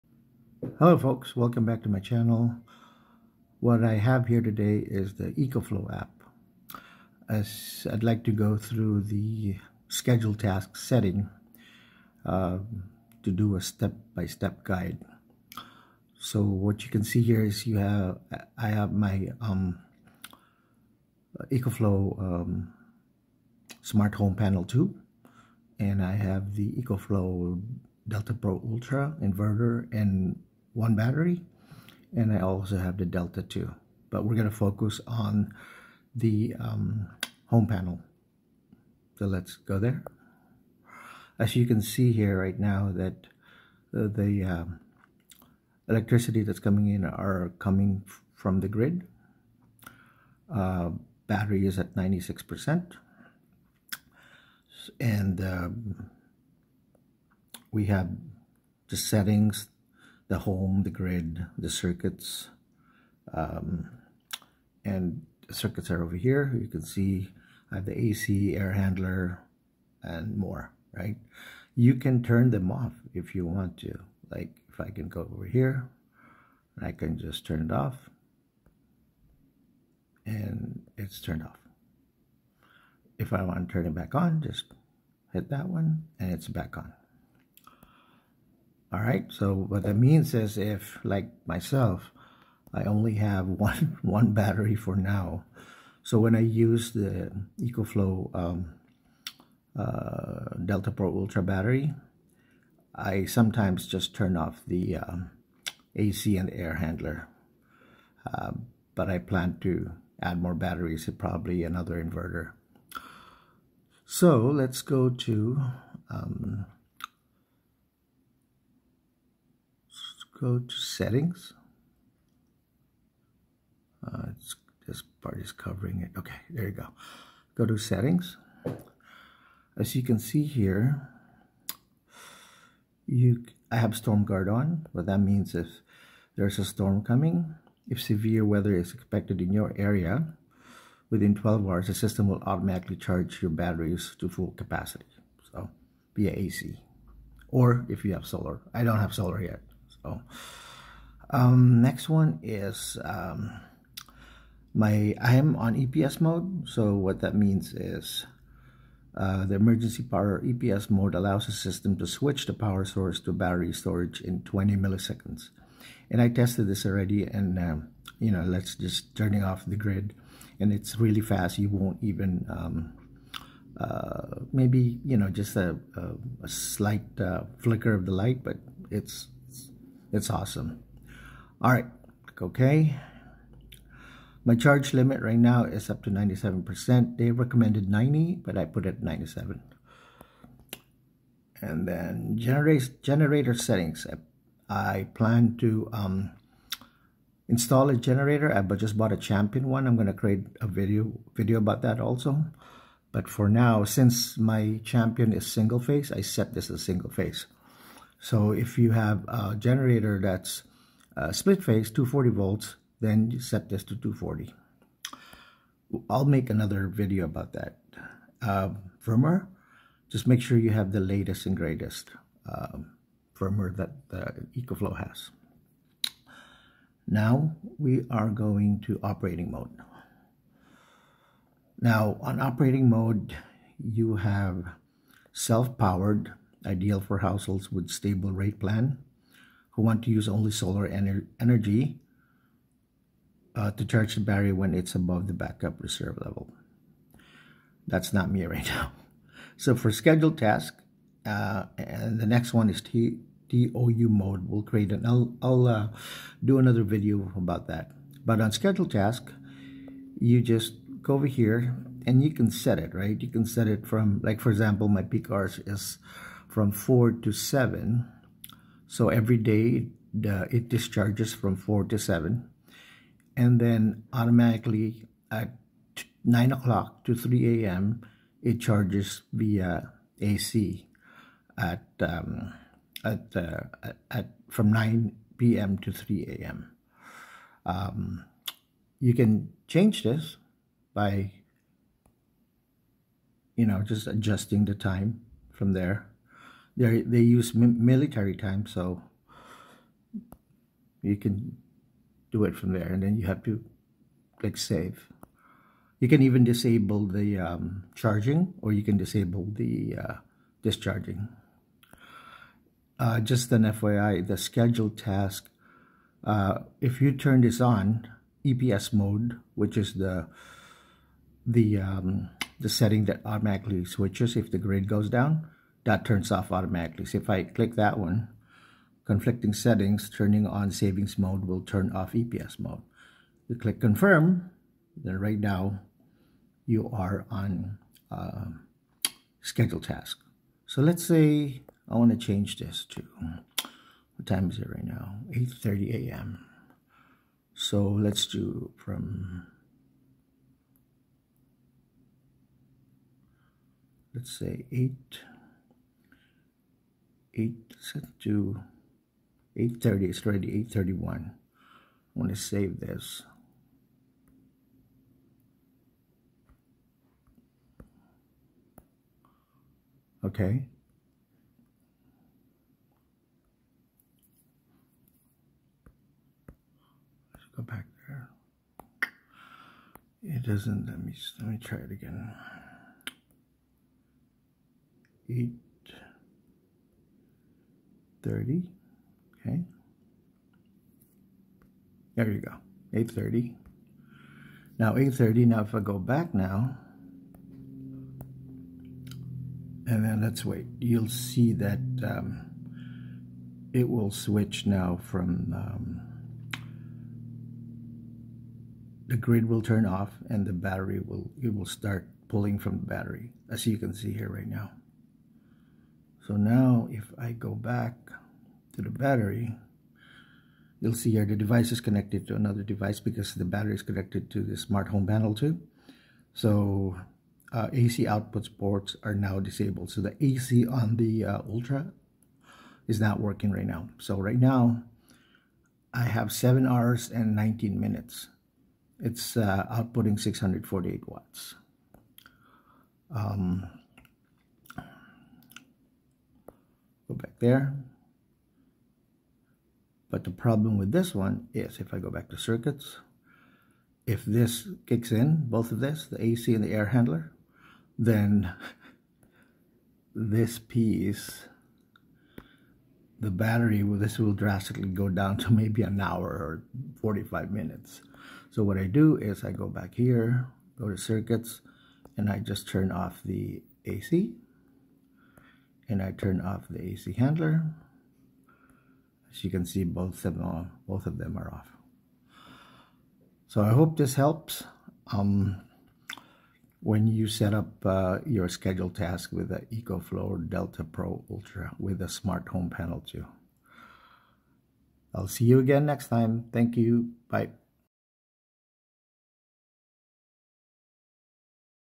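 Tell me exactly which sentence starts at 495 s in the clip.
I'll see you again next time.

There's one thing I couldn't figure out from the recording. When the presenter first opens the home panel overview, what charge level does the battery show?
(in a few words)
96%.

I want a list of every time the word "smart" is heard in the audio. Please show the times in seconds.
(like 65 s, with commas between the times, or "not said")
23 s, 424 s, 492 s.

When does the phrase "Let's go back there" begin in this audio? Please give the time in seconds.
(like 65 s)
377 s.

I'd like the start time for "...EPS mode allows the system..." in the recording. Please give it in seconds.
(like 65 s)
160 s.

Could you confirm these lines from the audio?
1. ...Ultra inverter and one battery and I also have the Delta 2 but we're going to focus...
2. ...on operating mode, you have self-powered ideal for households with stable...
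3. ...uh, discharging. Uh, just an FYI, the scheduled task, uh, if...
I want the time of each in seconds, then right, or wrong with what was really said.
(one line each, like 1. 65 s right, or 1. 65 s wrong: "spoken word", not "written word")
1. 28 s right
2. 232 s right
3. 310 s right.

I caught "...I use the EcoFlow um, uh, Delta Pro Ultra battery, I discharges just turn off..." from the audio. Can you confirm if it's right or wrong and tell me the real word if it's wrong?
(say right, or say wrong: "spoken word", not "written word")
wrong: "sometimes", not "discharges".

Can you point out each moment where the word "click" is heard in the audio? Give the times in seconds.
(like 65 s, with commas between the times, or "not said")
304 s, 327 s, 333 s.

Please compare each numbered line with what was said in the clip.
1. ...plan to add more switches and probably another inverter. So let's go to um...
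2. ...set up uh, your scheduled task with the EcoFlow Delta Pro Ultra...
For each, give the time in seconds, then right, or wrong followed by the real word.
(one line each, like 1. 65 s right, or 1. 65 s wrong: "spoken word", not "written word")
1. 109 s wrong: "batteries", not "switches"
2. 487 s right.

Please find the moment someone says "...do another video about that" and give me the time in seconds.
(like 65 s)
256 s.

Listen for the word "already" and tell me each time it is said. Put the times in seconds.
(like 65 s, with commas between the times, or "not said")
166 s, 360 s.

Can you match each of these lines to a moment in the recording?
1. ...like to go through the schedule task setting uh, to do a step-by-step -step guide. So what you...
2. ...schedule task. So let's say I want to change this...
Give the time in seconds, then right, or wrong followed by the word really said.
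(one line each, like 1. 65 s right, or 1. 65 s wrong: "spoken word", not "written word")
1. 8 s right
2. 339 s right.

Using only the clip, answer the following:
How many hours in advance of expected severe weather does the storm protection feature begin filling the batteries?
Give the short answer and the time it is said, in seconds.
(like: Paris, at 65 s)
12 hours, at 141 s.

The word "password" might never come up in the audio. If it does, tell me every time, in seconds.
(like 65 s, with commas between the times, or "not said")
not said.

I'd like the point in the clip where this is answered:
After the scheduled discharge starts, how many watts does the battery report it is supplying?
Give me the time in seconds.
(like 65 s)
440 s.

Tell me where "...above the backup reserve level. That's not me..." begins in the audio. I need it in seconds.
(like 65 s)
244 s.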